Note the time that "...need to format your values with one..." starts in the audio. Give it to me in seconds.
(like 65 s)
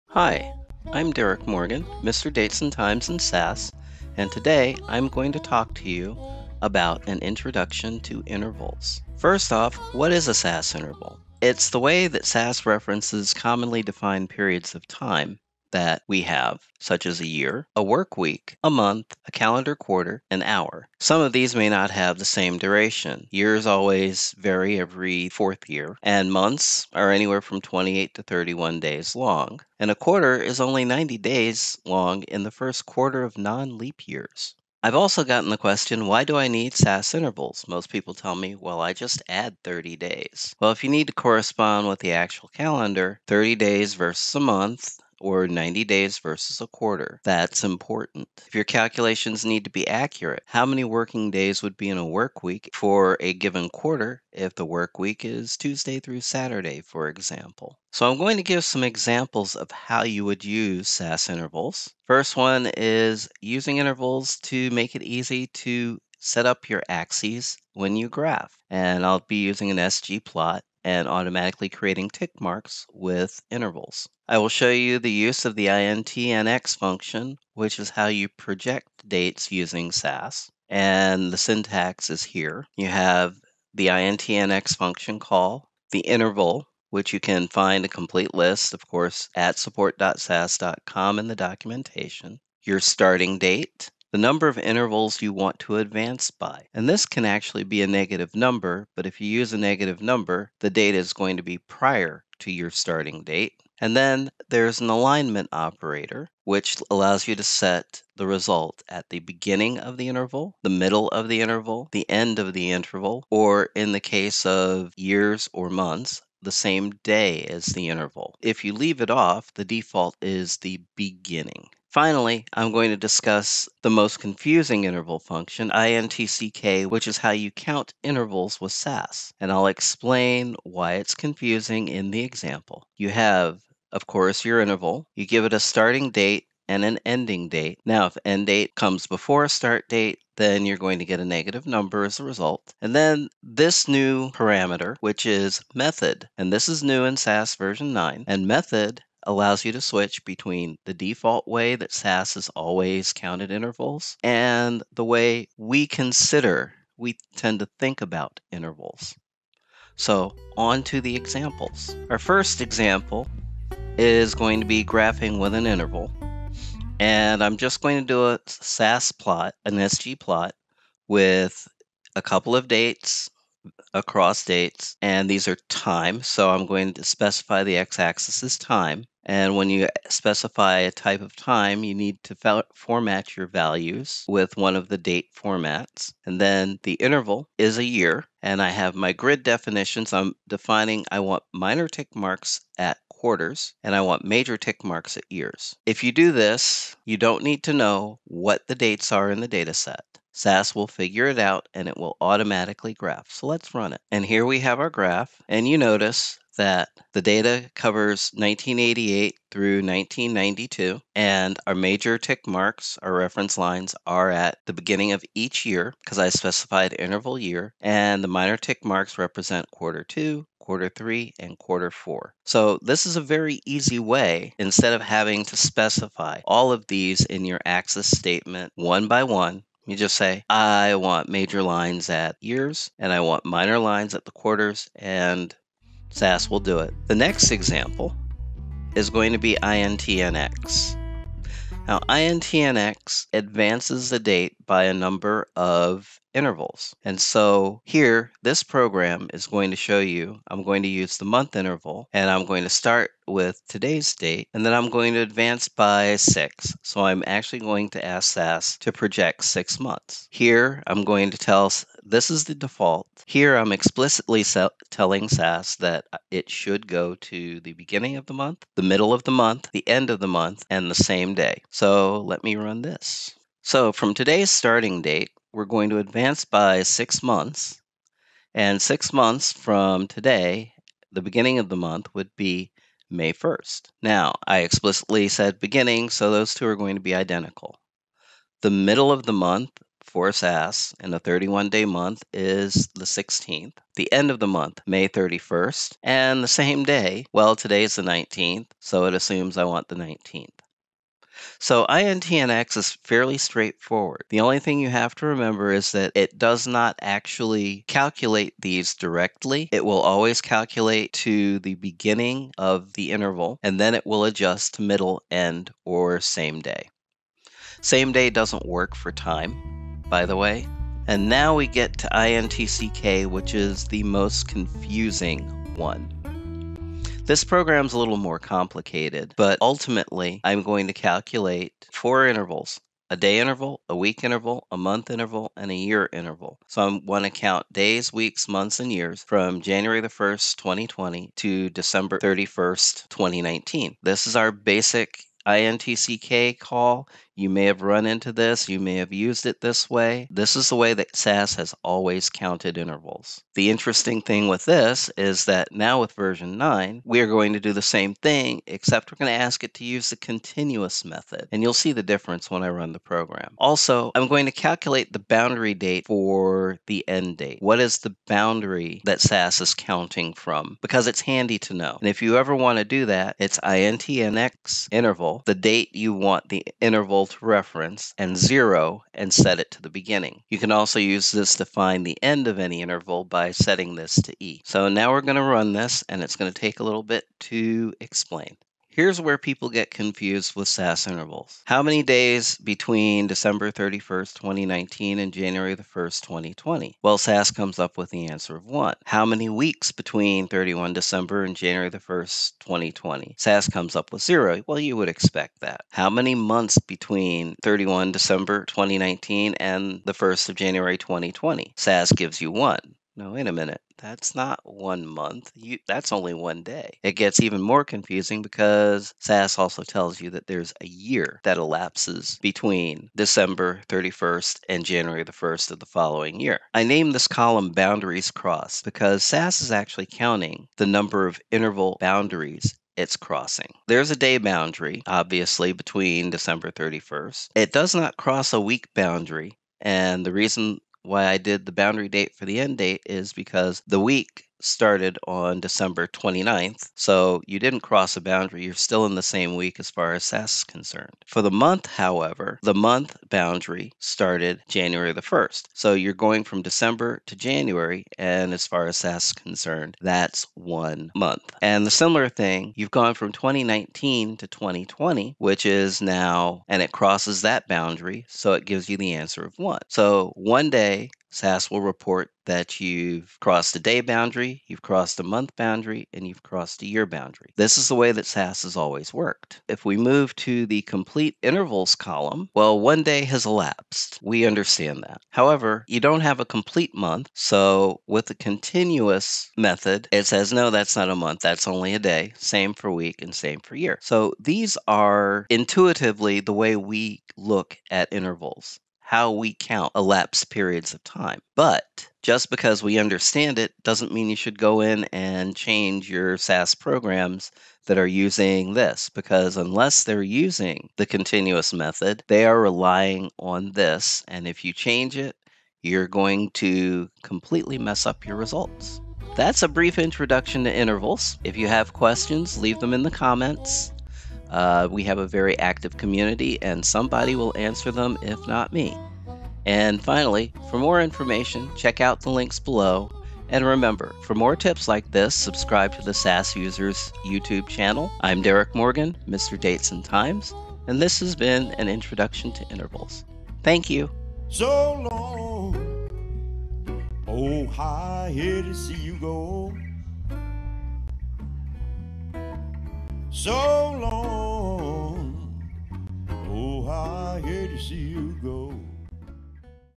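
181 s.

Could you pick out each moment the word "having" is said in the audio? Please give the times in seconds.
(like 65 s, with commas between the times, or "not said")
225 s.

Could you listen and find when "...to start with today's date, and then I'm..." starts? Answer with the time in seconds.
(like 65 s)
252 s.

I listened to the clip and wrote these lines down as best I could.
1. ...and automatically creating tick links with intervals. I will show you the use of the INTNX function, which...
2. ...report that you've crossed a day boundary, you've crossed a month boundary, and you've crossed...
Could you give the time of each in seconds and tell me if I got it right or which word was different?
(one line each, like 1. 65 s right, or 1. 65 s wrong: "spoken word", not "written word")
1. 70 s wrong: "marks", not "links"
2. 471 s right.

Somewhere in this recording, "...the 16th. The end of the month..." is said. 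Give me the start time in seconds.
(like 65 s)
292 s.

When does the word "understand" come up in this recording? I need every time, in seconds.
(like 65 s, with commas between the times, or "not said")
484 s, 502 s.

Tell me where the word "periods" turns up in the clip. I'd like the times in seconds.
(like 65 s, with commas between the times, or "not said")
14 s, 500 s.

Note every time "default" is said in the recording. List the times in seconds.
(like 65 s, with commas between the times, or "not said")
119 s, 150 s, 262 s.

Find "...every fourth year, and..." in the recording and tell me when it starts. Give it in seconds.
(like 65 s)
24 s.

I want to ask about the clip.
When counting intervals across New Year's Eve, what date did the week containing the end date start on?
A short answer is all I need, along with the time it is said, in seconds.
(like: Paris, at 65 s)
December 29th, at 445 s.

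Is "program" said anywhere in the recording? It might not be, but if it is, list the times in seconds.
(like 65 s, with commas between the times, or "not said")
248 s, 327 s, 362 s, 506 s.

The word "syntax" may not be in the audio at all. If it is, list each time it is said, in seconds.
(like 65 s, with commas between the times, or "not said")
81 s.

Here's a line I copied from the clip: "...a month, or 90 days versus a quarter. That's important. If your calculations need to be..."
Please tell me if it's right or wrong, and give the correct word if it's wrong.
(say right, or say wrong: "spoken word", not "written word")
right.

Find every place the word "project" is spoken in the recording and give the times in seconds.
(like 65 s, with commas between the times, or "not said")
78 s, 258 s.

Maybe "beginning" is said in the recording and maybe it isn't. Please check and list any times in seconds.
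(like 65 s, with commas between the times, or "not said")
109 s, 120 s, 214 s, 267 s, 281 s, 285 s, 311 s, 379 s.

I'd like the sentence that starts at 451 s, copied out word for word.
For the month, however, the month boundary started January the 1st.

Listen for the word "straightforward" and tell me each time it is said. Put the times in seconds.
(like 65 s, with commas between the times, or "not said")
303 s.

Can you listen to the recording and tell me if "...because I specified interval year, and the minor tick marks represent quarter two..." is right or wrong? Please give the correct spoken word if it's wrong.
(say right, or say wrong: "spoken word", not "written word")
right.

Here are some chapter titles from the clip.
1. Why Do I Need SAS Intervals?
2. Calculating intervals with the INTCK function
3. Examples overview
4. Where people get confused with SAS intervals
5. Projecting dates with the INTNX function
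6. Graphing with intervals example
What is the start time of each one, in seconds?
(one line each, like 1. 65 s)
1. 34 s
2. 320 s
3. 57 s
4. 388 s
5. 237 s
6. 160 s.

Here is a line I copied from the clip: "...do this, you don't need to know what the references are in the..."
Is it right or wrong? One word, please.
wrong.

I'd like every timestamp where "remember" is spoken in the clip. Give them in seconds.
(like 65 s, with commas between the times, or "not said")
305 s, 533 s.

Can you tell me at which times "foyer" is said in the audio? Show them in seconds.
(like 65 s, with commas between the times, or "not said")
not said.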